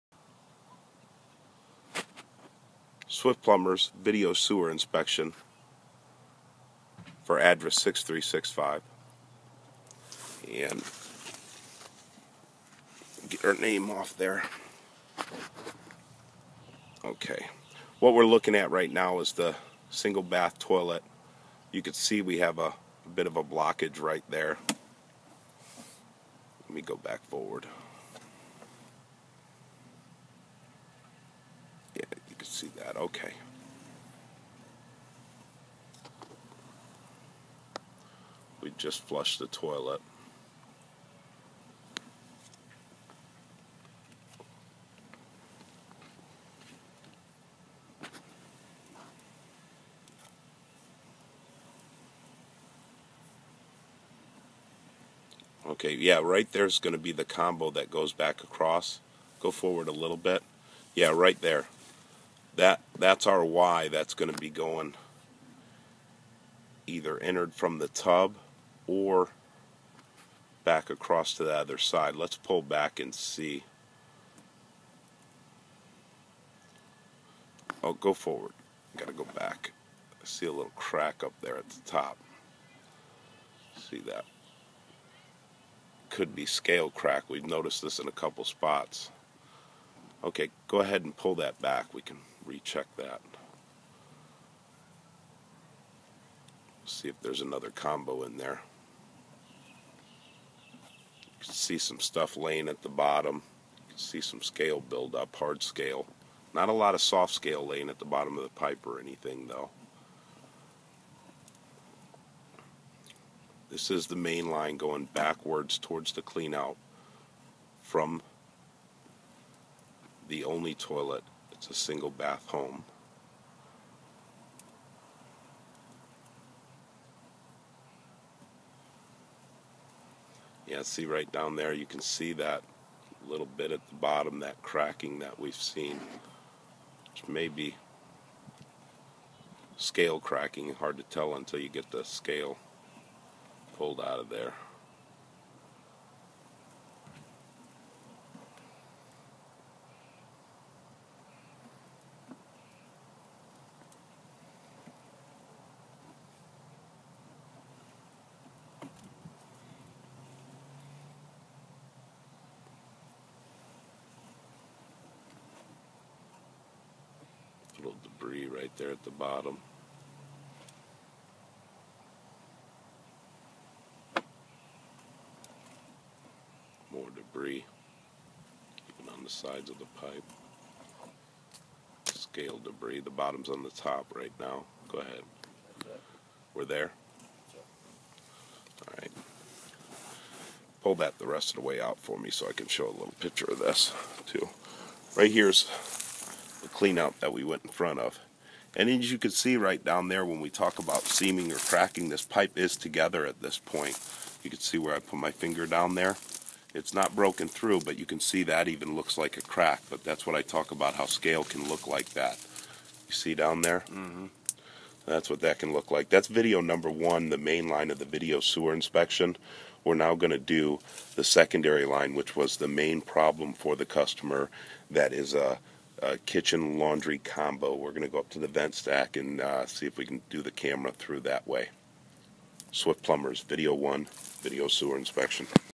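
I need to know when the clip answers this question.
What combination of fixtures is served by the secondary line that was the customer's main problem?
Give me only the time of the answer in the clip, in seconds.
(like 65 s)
226 s.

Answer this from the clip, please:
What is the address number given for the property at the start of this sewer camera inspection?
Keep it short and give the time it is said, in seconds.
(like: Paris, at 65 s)
6365, at 7 s.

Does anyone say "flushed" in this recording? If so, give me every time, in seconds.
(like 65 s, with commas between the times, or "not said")
39 s.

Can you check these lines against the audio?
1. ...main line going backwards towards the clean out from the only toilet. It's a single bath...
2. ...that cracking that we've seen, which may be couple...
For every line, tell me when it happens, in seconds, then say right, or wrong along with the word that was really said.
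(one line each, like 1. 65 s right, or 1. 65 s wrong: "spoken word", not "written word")
1. 114 s right
2. 134 s wrong: "scale", not "couple".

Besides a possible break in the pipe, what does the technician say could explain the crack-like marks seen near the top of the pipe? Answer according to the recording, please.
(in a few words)
scale crack.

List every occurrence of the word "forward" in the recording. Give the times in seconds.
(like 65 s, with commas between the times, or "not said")
27 s, 59 s, 78 s.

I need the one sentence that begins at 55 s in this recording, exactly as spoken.
Okay, yeah, right there's going to be the combo that goes back across.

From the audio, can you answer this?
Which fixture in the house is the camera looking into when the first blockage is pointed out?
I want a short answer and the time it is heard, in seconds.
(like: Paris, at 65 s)
single bath toilet, at 19 s.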